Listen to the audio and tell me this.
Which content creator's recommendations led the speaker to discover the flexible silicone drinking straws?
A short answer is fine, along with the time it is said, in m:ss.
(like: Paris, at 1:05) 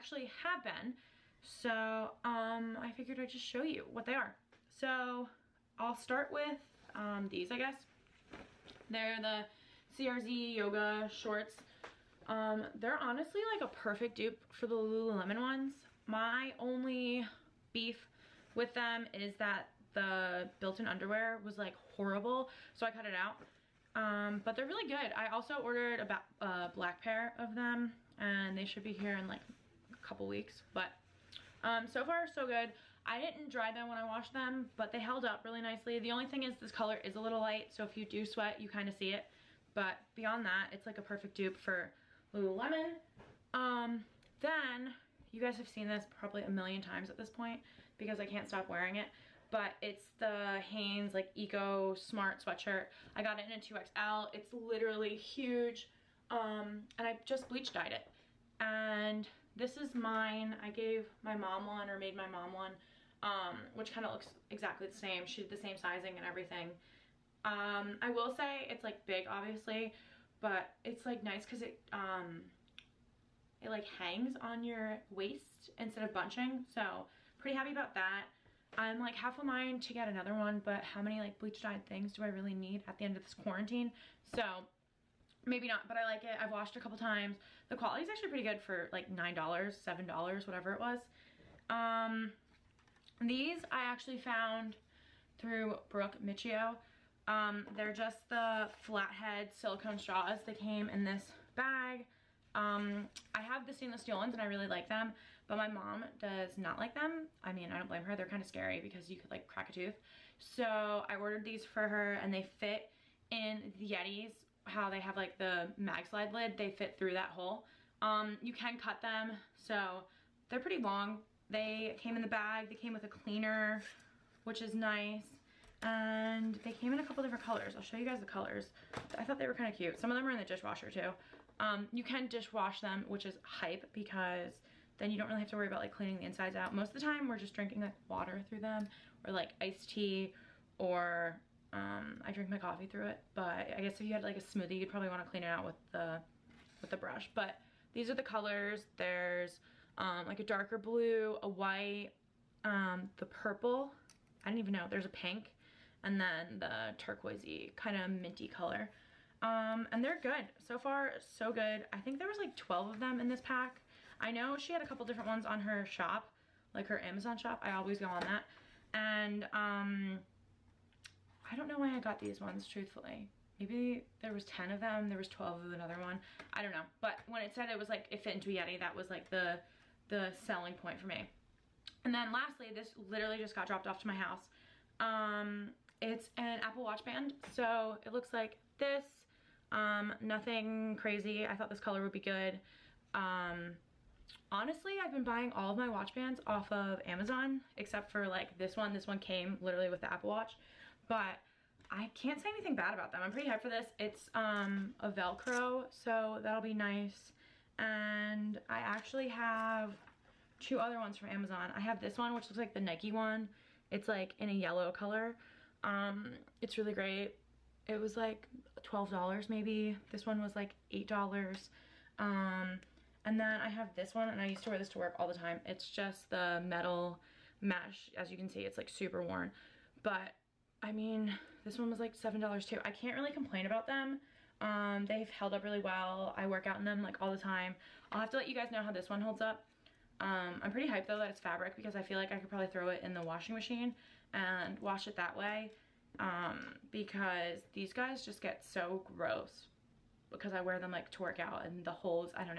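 Brooke Miccio, at 1:35.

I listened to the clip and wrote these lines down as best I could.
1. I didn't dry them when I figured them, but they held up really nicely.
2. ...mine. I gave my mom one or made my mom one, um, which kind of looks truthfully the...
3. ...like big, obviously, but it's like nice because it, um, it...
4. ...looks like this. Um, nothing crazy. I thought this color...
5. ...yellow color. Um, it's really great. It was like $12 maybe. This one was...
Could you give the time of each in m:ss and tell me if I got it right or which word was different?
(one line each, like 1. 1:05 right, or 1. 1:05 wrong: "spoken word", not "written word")
1. 0:33 wrong: "washed", not "figured"
2. 0:59 wrong: "exactly", not "truthfully"
3. 1:08 right
4. 3:08 right
5. 3:34 right.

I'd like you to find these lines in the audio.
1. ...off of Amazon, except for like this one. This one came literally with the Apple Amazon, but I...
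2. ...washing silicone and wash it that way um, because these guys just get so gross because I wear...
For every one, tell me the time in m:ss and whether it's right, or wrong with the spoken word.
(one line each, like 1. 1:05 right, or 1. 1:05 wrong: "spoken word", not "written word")
1. 3:16 wrong: "Watch", not "Amazon"
2. 4:03 wrong: "machine", not "silicone".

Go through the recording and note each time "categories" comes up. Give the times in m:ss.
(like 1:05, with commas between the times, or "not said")
not said.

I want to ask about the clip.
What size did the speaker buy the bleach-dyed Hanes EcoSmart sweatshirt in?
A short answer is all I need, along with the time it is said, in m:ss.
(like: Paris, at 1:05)
2XL, at 0:53.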